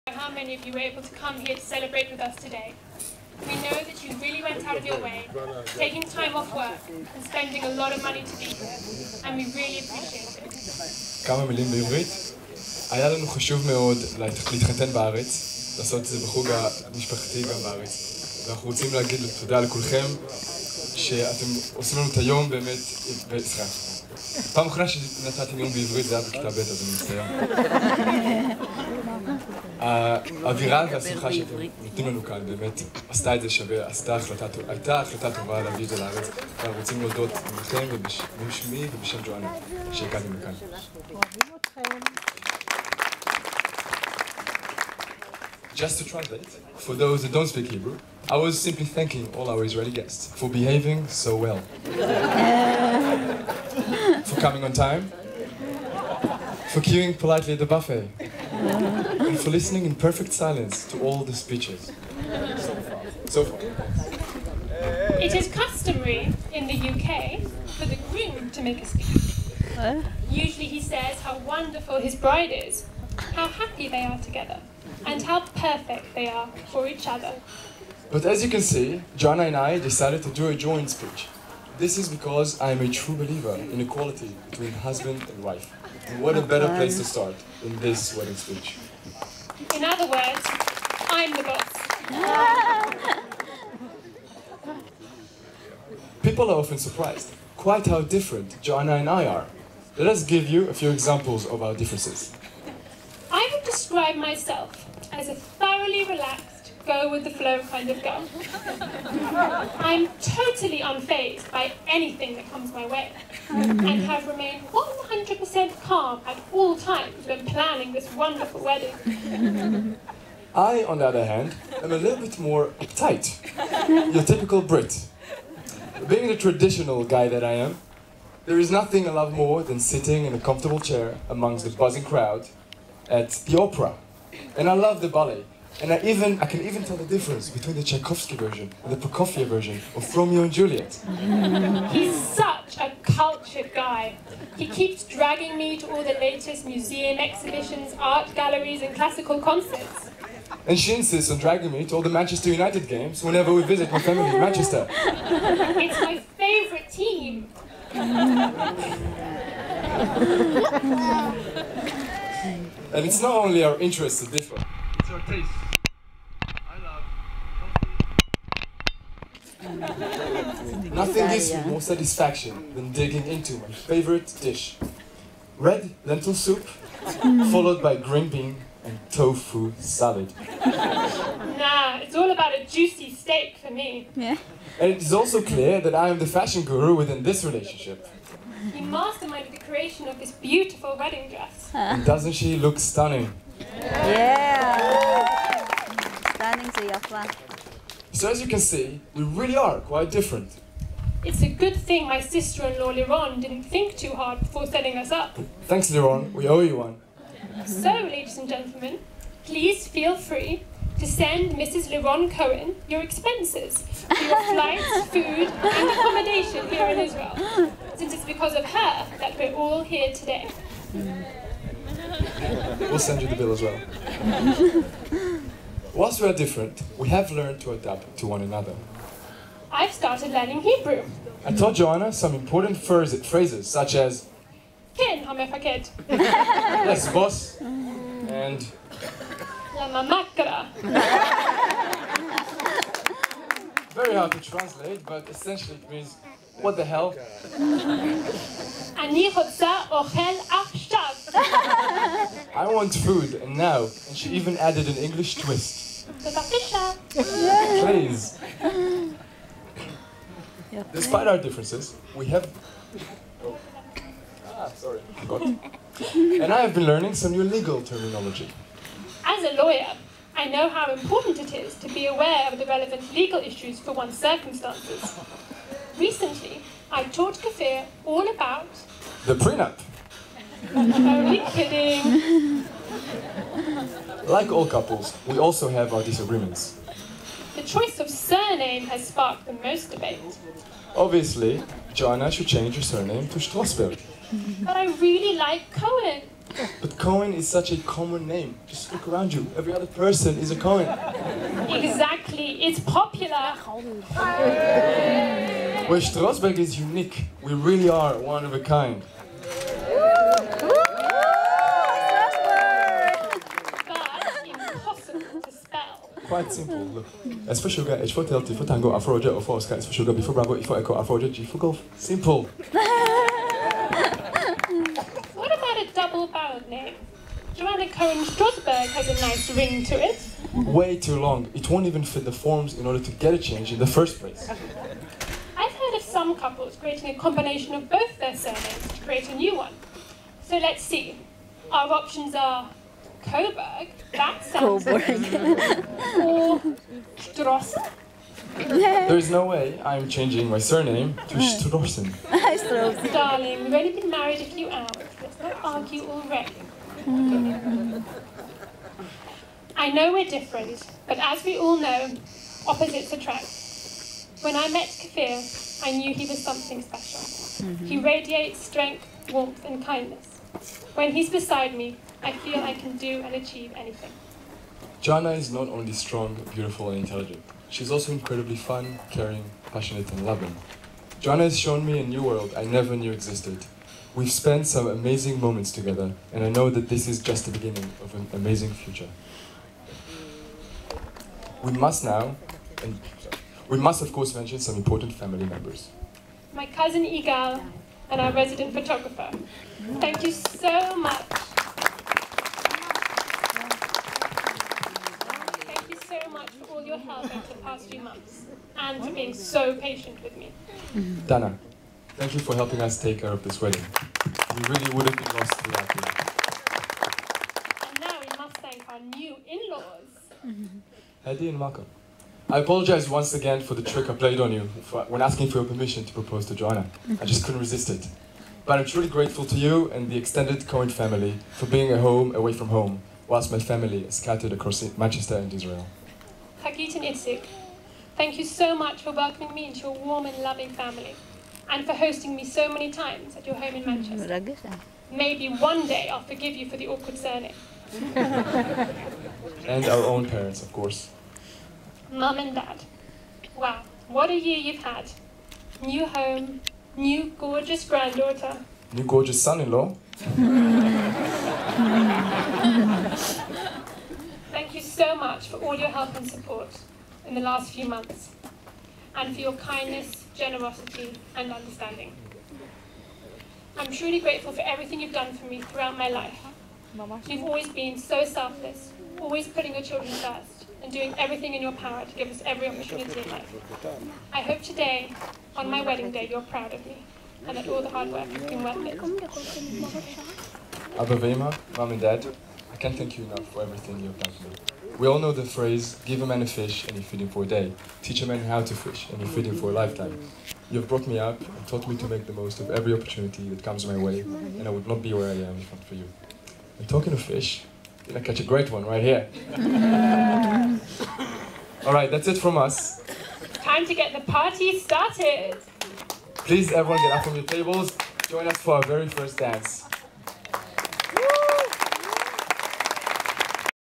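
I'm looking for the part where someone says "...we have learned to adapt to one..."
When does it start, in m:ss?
3:46.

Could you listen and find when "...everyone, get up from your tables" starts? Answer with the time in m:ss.
8:36.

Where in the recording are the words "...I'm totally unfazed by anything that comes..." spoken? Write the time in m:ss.
1:49.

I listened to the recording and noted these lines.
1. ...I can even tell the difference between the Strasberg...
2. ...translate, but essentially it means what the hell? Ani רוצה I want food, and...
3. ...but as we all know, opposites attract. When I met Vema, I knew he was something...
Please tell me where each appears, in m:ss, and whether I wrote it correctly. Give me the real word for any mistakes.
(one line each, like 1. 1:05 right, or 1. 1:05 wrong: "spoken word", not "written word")
1. 2:16 wrong: "Tchaikovsky", not "Strasberg"
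2. 4:04 right
3. 6:01 wrong: "Kfir", not "Vema".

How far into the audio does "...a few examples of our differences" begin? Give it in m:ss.
1:40.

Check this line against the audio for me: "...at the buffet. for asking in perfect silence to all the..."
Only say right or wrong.
wrong.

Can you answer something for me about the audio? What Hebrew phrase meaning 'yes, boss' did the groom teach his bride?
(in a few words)
Ken hamefaked.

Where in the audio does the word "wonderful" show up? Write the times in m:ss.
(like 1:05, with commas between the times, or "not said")
1:11, 1:58.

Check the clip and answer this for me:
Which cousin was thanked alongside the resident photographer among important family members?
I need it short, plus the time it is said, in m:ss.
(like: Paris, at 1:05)
Igal, at 6:37.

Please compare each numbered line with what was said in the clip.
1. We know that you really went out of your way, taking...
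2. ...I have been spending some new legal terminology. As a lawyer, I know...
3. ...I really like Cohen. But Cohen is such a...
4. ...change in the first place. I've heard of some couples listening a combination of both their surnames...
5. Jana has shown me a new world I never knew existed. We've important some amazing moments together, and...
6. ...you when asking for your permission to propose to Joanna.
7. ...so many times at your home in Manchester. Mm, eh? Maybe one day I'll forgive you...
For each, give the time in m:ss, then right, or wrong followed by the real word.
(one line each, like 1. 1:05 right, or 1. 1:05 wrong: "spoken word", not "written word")
1. 0:03 right
2. 4:26 wrong: "learning", not "spending"
3. 4:54 right
4. 5:33 wrong: "creating", not "listening"
5. 6:21 wrong: "spent", not "important"
6. 7:04 right
7. 7:22 right.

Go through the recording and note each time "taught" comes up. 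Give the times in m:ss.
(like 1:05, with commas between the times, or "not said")
3:51, 4:37, 8:21.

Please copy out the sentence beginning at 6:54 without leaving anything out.
We really would have been lost without you.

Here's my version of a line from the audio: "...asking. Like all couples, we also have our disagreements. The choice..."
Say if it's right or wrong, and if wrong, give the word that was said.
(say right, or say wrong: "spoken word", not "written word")
wrong: "kidding", not "asking".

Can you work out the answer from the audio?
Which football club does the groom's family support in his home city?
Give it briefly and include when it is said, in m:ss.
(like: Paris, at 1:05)
Manchester United, at 2:32.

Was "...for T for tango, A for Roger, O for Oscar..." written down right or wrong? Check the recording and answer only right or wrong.
right.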